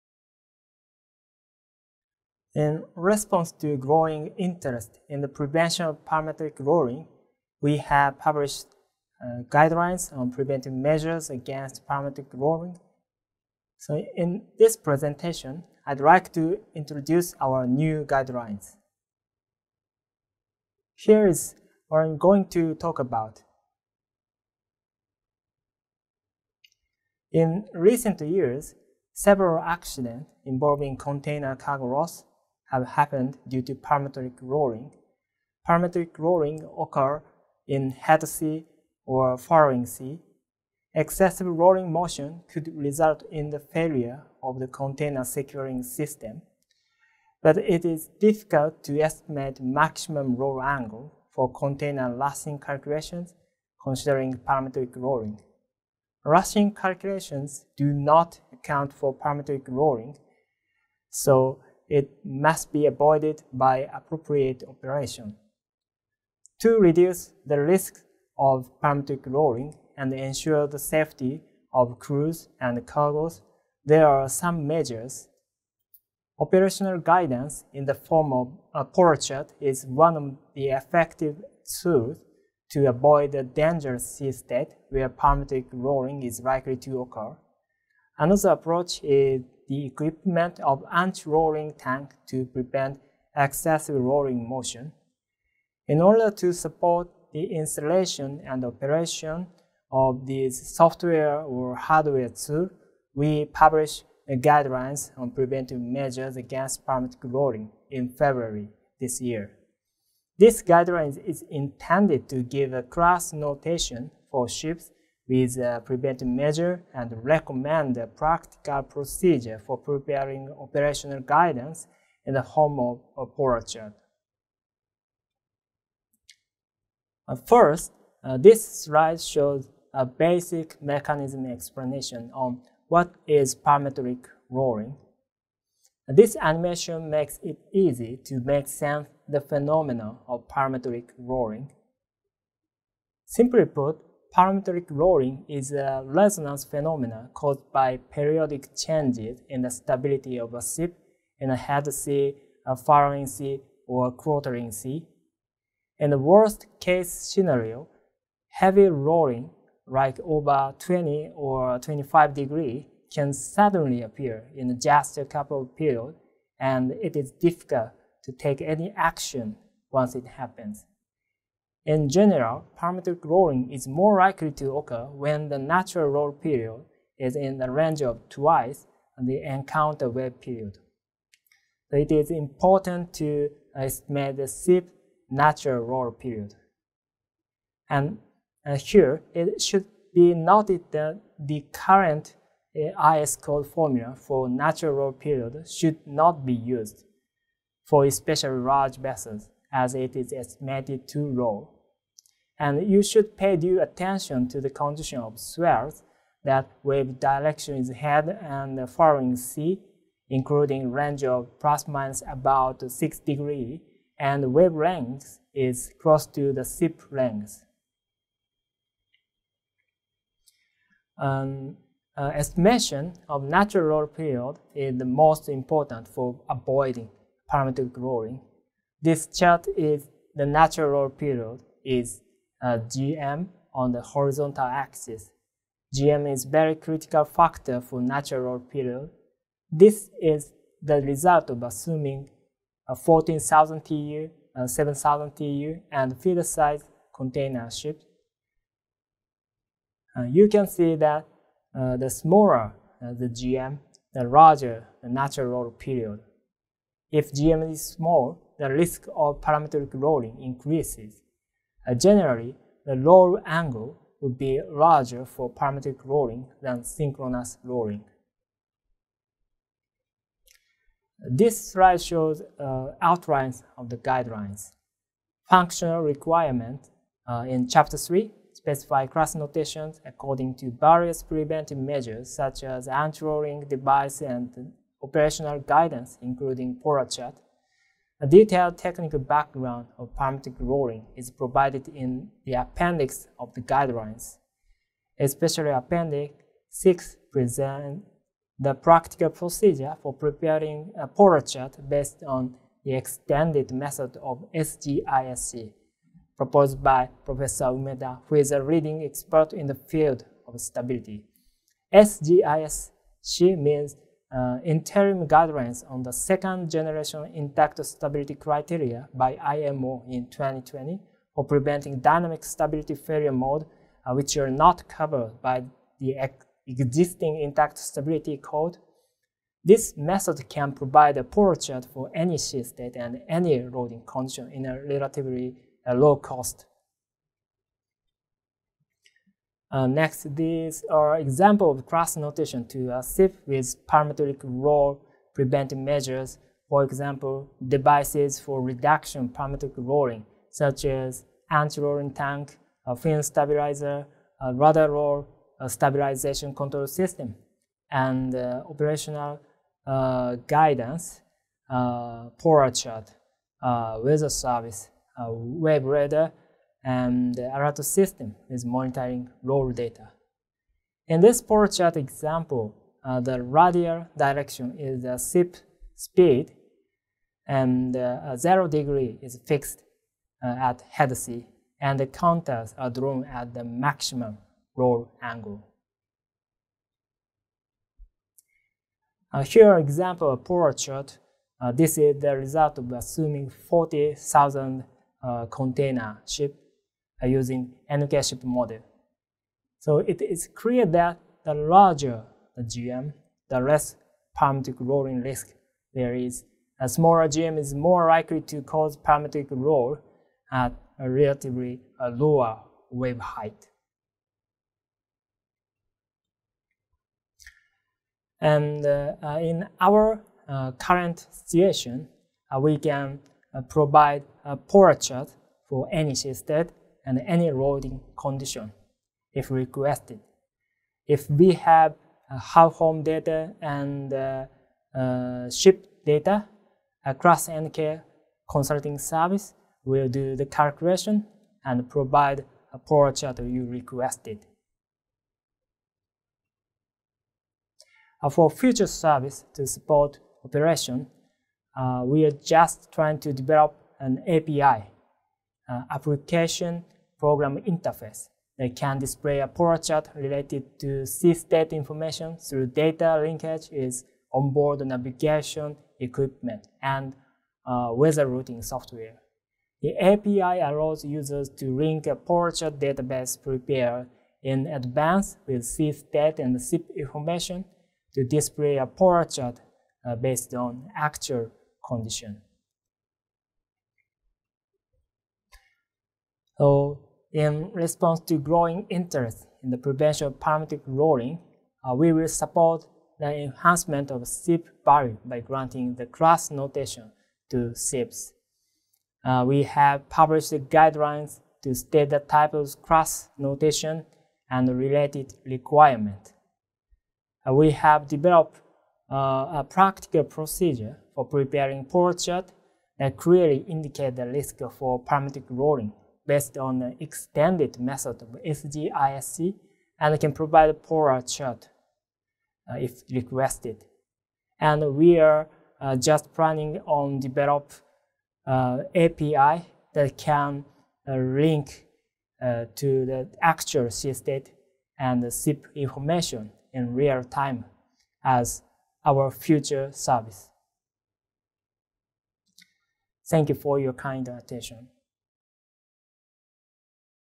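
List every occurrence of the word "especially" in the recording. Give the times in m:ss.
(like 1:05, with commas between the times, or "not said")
3:18, 4:55.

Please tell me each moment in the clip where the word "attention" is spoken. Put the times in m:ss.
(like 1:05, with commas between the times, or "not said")
3:23, 9:04.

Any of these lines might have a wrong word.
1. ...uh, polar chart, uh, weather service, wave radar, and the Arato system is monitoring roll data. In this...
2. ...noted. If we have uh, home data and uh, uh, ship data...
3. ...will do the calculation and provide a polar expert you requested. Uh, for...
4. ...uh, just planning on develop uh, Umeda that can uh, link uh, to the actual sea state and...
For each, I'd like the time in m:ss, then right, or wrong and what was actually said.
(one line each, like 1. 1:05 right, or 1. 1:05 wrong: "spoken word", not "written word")
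1. 6:01 right
2. 7:09 wrong: "requested", not "noted"
3. 7:19 wrong: "chart", not "expert"
4. 8:45 wrong: "API", not "Umeda".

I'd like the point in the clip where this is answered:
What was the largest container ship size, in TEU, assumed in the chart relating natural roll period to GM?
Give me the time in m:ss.
4:02.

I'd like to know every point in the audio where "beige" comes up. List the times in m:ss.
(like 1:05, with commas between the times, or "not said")
not said.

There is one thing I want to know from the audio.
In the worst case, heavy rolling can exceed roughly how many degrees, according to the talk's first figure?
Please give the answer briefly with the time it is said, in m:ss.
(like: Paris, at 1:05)
20, at 2:40.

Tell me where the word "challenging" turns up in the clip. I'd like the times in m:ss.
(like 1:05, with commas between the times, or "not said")
not said.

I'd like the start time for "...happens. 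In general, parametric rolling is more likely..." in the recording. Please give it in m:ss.
2:50.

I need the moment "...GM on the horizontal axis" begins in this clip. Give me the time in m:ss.
3:52.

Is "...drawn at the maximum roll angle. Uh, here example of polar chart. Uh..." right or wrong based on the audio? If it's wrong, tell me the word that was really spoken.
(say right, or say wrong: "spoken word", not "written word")
right.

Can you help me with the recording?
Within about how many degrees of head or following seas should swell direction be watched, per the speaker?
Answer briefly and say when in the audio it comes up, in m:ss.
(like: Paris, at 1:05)
6 degrees, at 3:32.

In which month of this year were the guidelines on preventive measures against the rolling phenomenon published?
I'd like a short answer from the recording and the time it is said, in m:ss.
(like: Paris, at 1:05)
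February, at 1:48.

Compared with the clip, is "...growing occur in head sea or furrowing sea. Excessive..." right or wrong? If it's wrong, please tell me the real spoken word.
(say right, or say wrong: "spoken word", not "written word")
wrong: "rolling", not "growing".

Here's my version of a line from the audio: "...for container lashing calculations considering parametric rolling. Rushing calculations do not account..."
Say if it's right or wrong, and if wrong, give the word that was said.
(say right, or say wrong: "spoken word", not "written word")
right.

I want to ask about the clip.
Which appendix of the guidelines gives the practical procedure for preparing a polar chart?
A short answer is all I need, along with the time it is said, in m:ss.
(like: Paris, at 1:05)
Appendix 6, at 4:55.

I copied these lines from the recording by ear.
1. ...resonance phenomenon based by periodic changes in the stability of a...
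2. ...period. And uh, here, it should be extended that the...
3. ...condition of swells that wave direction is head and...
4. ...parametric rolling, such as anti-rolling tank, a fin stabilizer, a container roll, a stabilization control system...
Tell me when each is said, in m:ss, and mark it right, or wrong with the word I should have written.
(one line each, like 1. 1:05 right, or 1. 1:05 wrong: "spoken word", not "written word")
1. 2:26 wrong: "caused", not "based"
2. 3:06 wrong: "noted", not "extended"
3. 3:24 right
4. 5:49 wrong: "rudder", not "container".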